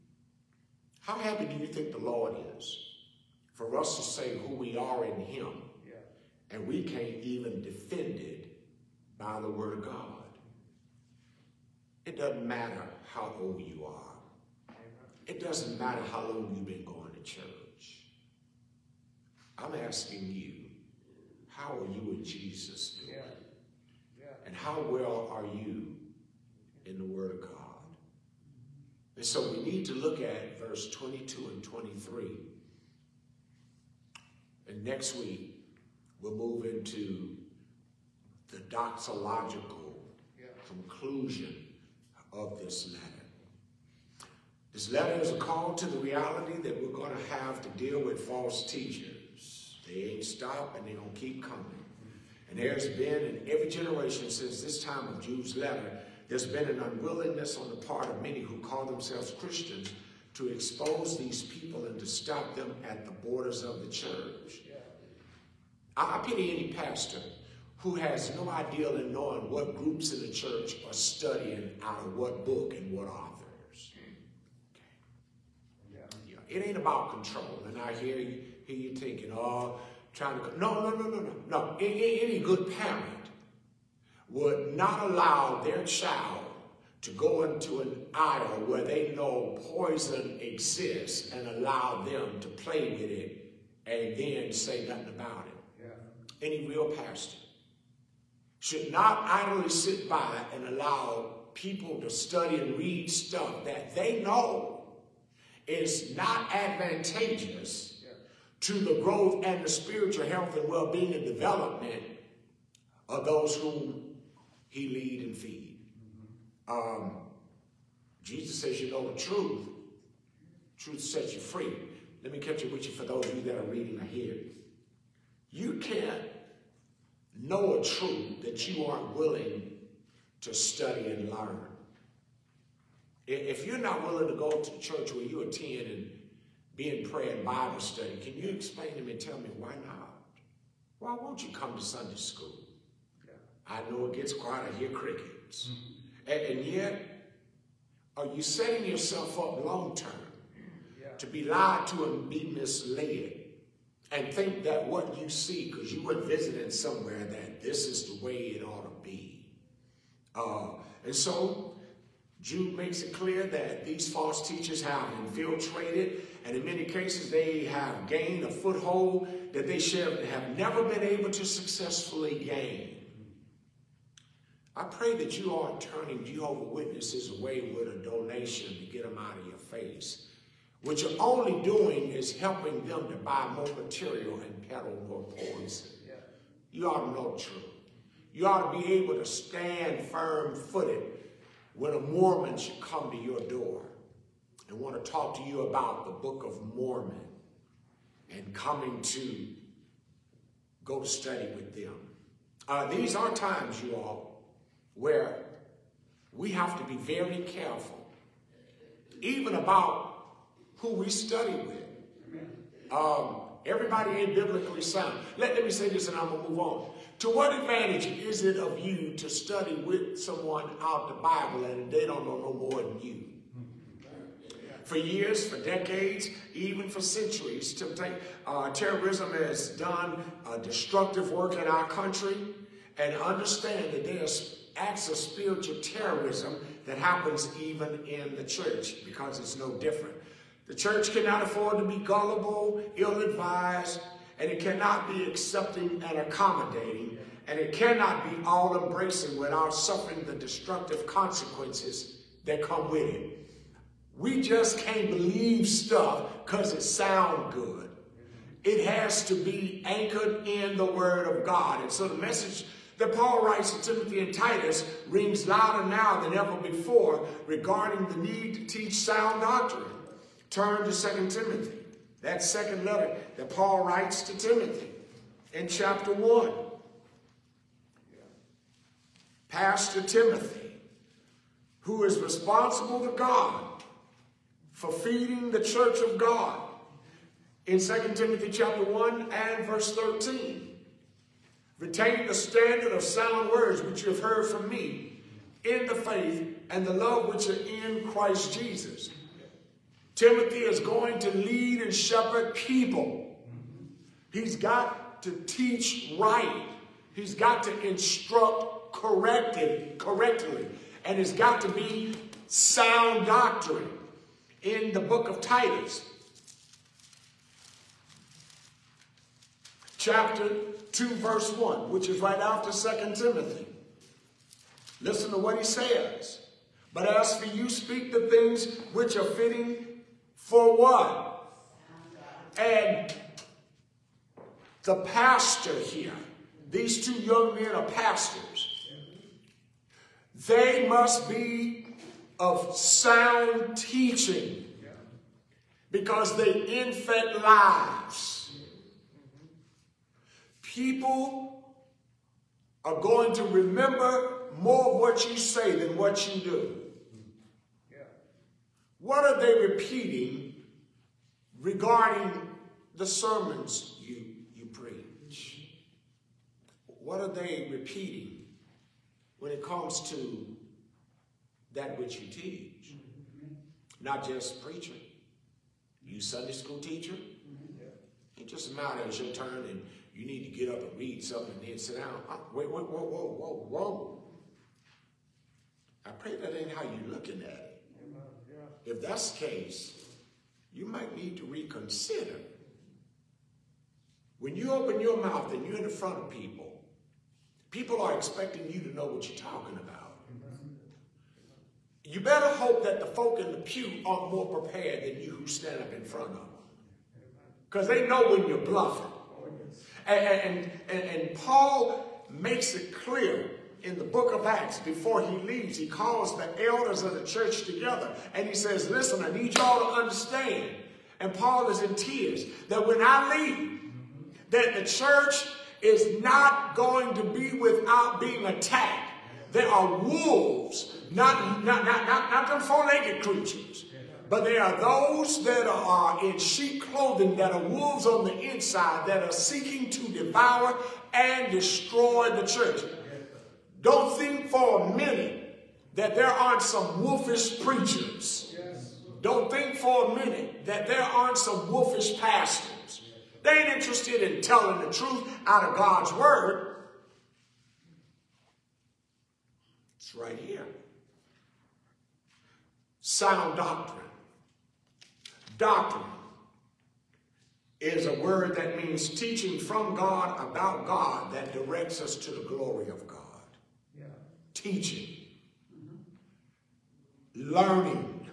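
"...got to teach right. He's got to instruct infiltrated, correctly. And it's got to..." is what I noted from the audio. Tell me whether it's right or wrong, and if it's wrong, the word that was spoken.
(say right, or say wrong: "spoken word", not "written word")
wrong: "corrected", not "infiltrated".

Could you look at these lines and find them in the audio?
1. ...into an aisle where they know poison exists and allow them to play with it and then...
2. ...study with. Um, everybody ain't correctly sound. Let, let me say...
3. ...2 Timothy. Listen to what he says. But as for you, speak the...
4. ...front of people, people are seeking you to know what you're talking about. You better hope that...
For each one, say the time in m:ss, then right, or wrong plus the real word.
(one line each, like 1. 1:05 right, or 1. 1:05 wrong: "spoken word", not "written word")
1. 1:27 right
2. 3:31 wrong: "biblically", not "correctly"
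3. 5:22 right
4. 6:35 wrong: "expecting", not "seeking".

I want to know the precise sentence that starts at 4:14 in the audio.
We just can't believe stuff because it sounds good.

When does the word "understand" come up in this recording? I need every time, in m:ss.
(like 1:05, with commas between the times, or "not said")
3:53, 7:00.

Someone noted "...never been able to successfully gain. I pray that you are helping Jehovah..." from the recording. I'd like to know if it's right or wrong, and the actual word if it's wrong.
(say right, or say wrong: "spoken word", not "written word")
wrong: "turning", not "helping".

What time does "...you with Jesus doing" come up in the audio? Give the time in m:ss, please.
0:21.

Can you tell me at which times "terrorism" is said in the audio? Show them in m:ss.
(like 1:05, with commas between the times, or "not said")
3:48, 3:55.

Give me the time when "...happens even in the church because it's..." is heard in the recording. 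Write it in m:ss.
3:56.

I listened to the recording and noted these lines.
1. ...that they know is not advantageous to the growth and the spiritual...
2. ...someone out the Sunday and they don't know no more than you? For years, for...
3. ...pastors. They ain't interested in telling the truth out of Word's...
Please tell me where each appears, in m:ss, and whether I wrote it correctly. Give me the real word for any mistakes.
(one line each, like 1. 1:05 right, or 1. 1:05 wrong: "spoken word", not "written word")
1. 1:43 right
2. 3:40 wrong: "Bible", not "Sunday"
3. 7:32 wrong: "God", not "Word".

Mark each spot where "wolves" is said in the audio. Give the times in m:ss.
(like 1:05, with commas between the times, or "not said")
7:09, 7:17.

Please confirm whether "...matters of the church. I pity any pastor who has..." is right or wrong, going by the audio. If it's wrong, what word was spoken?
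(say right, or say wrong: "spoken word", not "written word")
wrong: "borders", not "matters".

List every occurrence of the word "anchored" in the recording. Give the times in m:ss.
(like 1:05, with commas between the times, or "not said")
4:19.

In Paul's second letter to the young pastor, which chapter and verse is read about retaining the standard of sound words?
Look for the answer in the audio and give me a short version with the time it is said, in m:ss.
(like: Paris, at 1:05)
Chapter 1, verse 13, at 4:48.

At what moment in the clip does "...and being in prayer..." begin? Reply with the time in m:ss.
2:15.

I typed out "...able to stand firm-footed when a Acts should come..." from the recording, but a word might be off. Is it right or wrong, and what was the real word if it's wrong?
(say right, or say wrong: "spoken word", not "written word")
wrong: "Mormon", not "Acts".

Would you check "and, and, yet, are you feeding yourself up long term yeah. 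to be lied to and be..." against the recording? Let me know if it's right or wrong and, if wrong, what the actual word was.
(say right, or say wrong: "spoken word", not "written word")
wrong: "setting", not "feeding".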